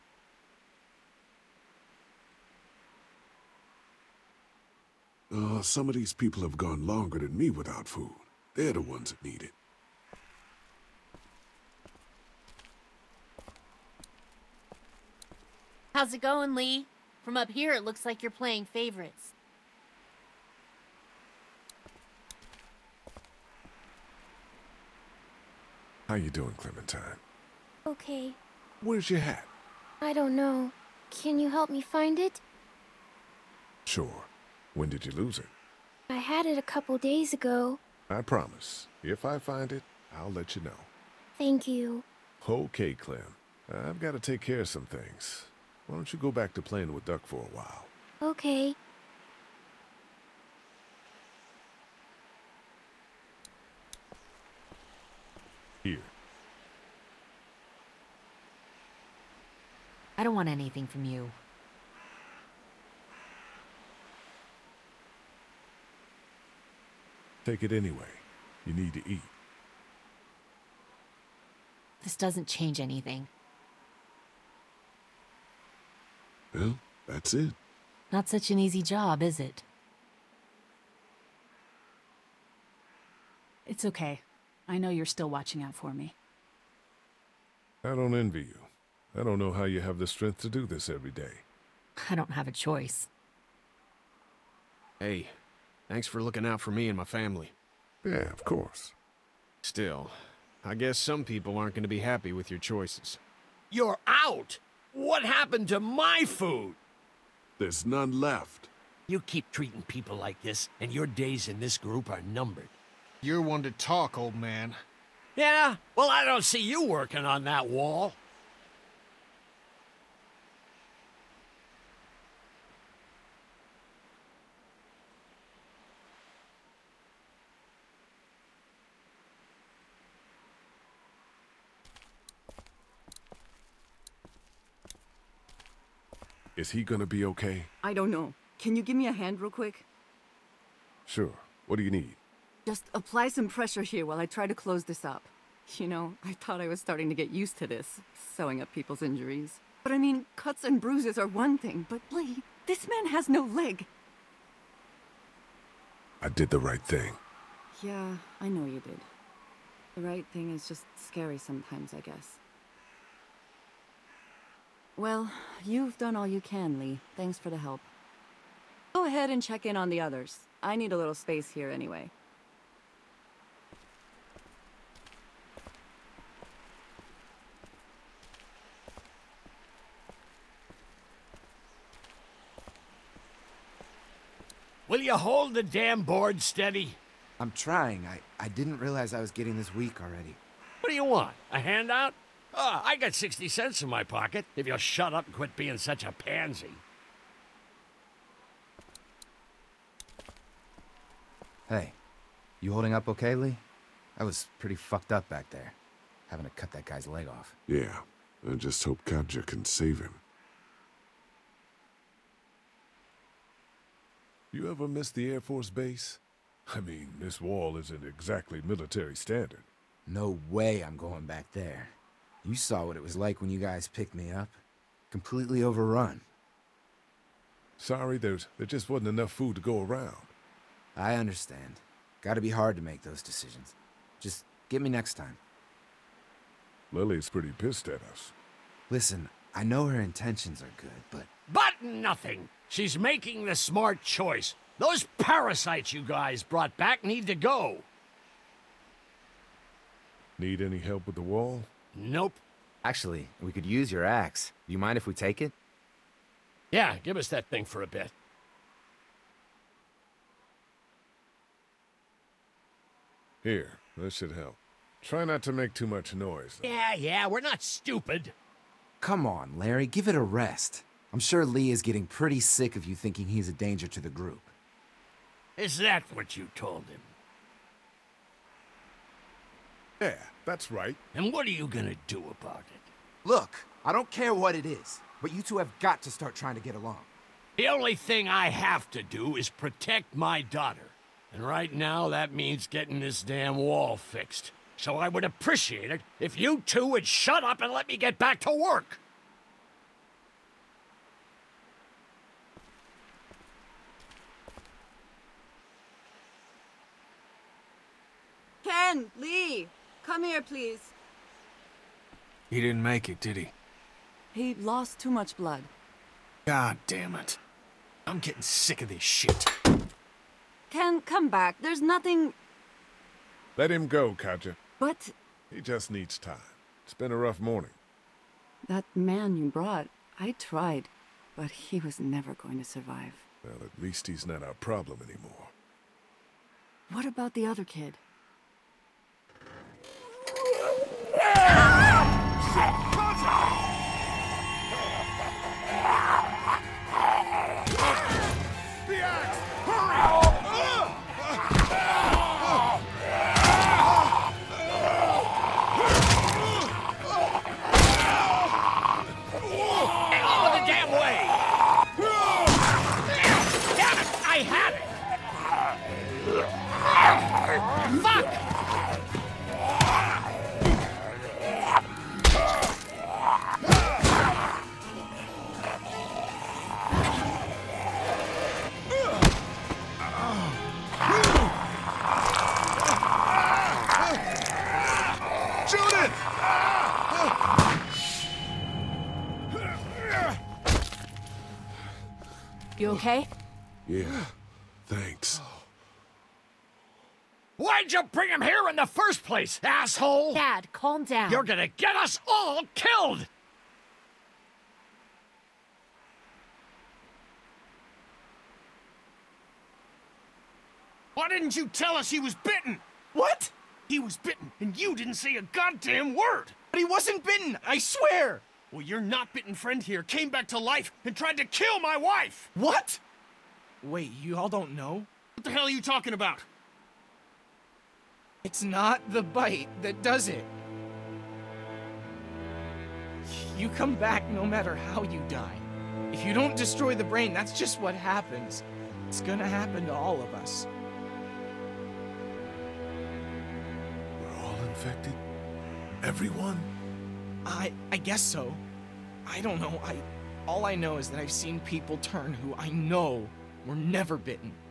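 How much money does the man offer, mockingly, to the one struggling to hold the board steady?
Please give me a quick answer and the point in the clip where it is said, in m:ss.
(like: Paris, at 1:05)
60 cents, at 3:13.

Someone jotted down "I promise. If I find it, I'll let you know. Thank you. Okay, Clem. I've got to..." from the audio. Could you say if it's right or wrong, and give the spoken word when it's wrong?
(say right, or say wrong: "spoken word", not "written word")
right.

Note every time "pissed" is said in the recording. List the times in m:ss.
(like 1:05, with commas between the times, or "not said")
3:57.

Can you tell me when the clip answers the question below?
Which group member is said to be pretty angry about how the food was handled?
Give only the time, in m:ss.
3:56.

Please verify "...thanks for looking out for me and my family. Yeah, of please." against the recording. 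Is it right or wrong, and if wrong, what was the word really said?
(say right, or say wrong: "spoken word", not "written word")
wrong: "course", not "please".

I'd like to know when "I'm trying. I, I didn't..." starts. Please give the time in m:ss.
3:07.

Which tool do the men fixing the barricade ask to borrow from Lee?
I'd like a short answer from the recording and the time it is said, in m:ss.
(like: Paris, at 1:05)
Axe, at 4:14.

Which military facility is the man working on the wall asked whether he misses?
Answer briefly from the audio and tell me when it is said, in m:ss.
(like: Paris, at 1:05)
The Air Force Base, at 3:35.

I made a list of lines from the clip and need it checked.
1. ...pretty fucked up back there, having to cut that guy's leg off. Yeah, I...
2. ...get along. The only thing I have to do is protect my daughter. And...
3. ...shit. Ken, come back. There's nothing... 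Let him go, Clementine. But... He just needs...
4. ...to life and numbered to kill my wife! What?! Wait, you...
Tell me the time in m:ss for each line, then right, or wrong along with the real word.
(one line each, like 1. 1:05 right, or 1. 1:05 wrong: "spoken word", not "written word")
1. 3:24 right
2. 4:46 right
3. 5:19 wrong: "Katja", not "Clementine"
4. 7:00 wrong: "tried", not "numbered".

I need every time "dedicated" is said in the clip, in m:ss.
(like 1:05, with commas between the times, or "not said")
not said.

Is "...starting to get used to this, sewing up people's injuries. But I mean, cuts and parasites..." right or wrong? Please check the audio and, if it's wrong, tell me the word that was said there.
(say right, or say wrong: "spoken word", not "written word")
wrong: "bruises", not "parasites".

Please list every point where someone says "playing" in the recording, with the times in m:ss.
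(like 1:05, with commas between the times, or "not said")
0:18, 0:46.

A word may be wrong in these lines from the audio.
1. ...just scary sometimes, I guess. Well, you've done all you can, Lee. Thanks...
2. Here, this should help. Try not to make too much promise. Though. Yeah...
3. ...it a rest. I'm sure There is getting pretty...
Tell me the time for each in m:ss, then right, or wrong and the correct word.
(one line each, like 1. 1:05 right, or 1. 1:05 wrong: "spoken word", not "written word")
1. 2:40 right
2. 4:23 wrong: "noise", not "promise"
3. 4:30 wrong: "Lee", not "There".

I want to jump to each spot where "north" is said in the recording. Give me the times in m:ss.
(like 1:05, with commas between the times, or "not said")
not said.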